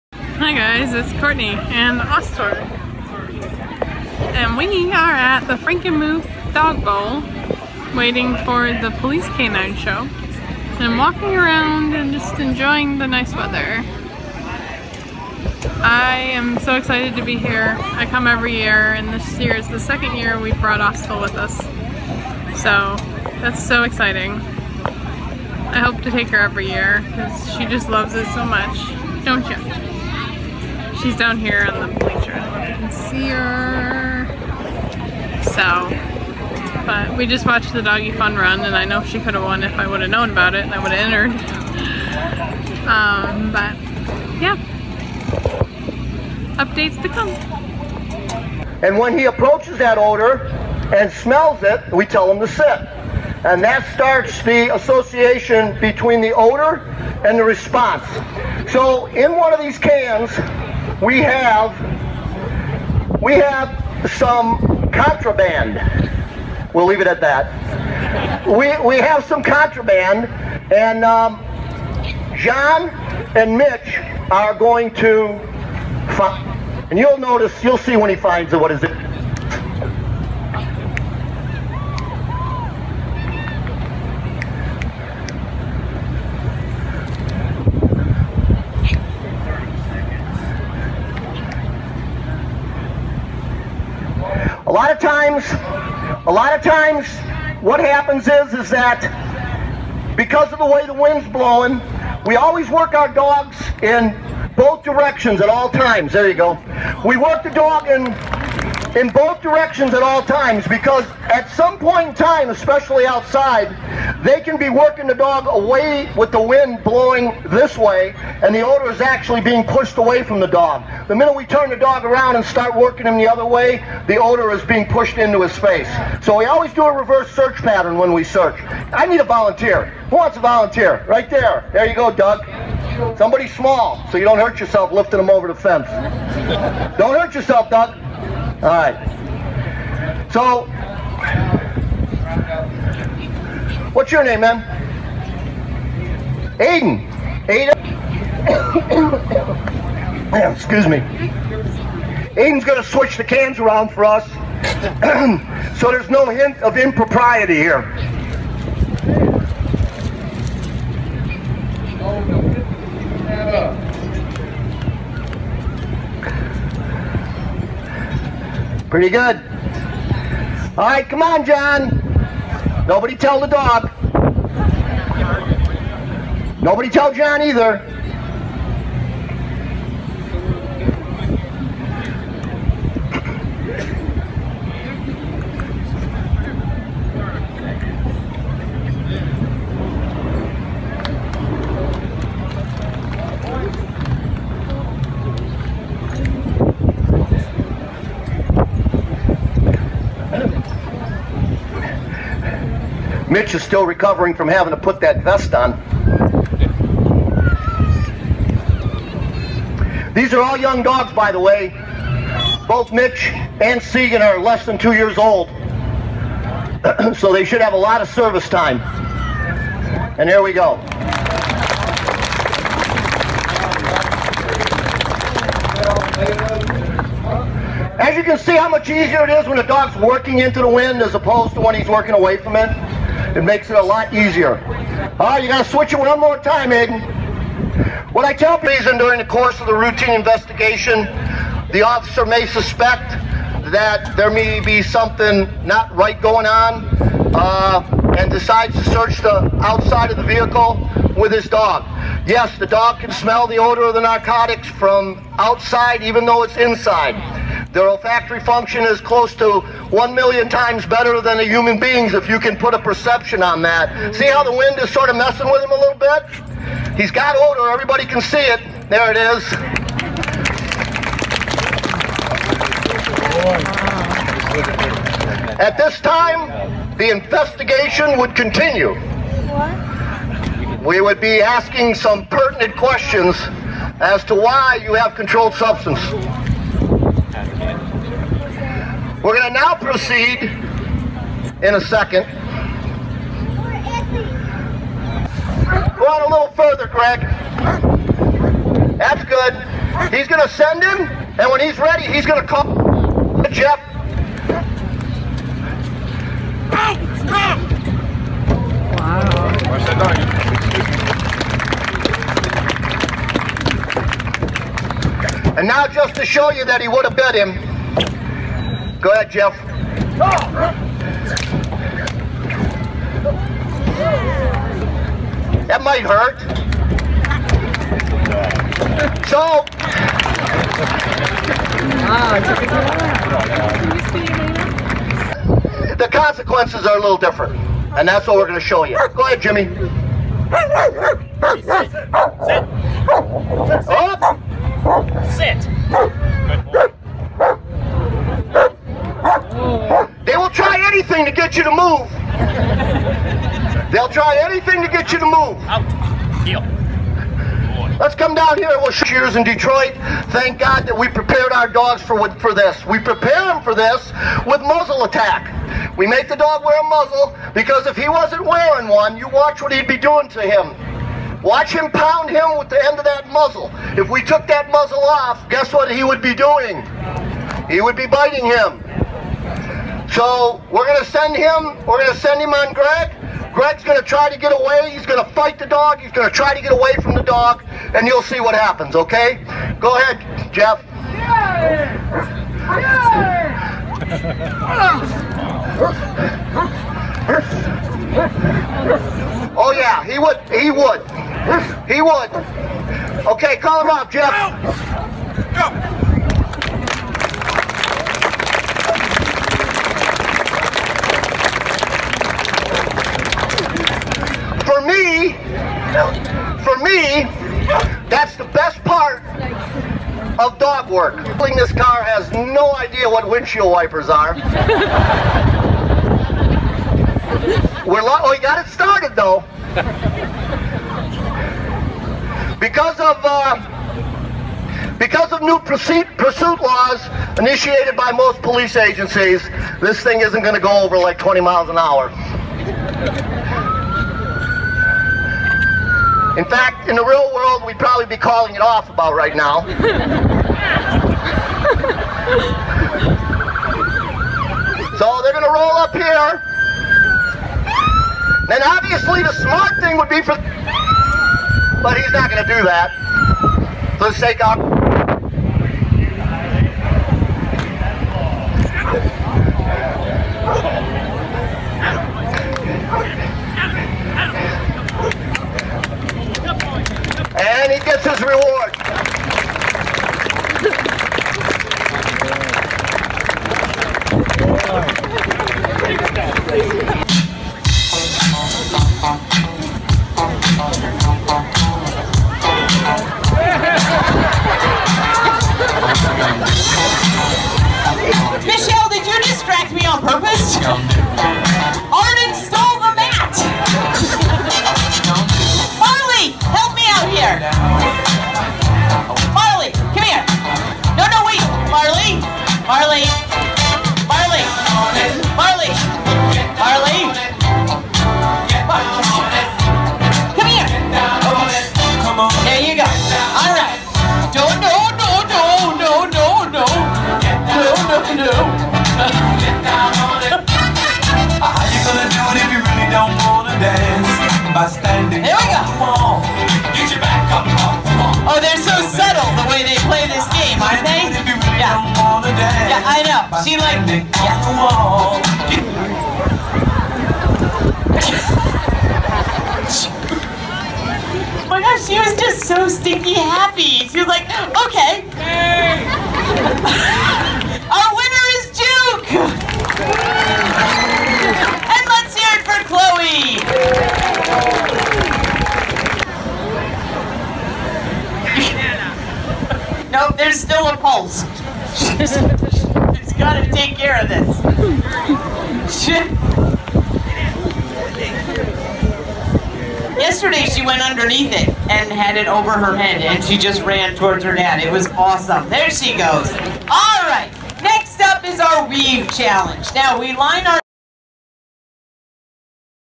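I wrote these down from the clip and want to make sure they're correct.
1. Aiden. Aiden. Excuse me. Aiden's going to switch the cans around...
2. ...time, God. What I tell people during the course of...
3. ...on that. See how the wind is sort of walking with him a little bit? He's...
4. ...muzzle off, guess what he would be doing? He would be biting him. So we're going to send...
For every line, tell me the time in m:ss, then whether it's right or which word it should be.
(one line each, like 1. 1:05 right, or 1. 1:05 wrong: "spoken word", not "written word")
1. 2:26 right
2. 3:56 wrong: "Aiden", not "God"
3. 4:23 wrong: "messing", not "walking"
4. 6:14 right.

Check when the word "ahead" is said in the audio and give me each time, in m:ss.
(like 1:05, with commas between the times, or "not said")
5:19, 5:39, 6:29.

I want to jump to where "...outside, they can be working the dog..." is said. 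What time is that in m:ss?
1:53.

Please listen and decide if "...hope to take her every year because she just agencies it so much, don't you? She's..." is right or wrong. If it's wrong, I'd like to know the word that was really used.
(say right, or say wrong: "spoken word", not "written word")
wrong: "loves", not "agencies".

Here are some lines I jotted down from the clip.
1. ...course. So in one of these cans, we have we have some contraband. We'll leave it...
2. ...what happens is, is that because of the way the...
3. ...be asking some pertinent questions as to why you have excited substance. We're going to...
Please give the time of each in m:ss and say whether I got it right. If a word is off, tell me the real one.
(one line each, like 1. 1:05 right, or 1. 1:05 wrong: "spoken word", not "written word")
1. 0:57 wrong: "response", not "course"
2. 1:37 right
3. 4:41 wrong: "controlled", not "excited".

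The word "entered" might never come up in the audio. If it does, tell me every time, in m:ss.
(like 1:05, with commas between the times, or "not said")
0:41.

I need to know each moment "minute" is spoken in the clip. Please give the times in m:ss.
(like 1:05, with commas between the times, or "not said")
2:01.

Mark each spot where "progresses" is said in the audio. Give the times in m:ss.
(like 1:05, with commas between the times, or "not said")
not said.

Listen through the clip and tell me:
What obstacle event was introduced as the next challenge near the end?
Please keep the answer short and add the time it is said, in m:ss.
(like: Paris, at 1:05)
weave challenge, at 9:48.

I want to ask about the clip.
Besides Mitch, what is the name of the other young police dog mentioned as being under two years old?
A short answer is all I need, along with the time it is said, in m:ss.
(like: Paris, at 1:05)
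Segan, at 3:33.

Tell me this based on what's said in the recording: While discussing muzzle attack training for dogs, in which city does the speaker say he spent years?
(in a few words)
Detroit.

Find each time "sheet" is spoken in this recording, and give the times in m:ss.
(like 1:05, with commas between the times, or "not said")
not said.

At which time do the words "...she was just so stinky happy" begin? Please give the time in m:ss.
9:11.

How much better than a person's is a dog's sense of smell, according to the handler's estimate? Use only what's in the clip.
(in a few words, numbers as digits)
1 million times.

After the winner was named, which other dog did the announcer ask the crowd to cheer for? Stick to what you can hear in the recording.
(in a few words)
Chloe.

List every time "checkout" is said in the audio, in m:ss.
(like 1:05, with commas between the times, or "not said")
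not said.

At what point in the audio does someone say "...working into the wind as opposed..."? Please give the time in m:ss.
3:50.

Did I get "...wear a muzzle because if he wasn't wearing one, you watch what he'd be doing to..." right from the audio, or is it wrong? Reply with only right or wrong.
right.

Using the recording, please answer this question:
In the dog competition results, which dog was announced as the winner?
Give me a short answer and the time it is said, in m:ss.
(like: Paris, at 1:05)
Juke, at 9:18.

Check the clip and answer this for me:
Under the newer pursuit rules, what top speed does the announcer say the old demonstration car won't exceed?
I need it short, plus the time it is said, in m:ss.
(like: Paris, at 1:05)
20 mph, at 7:21.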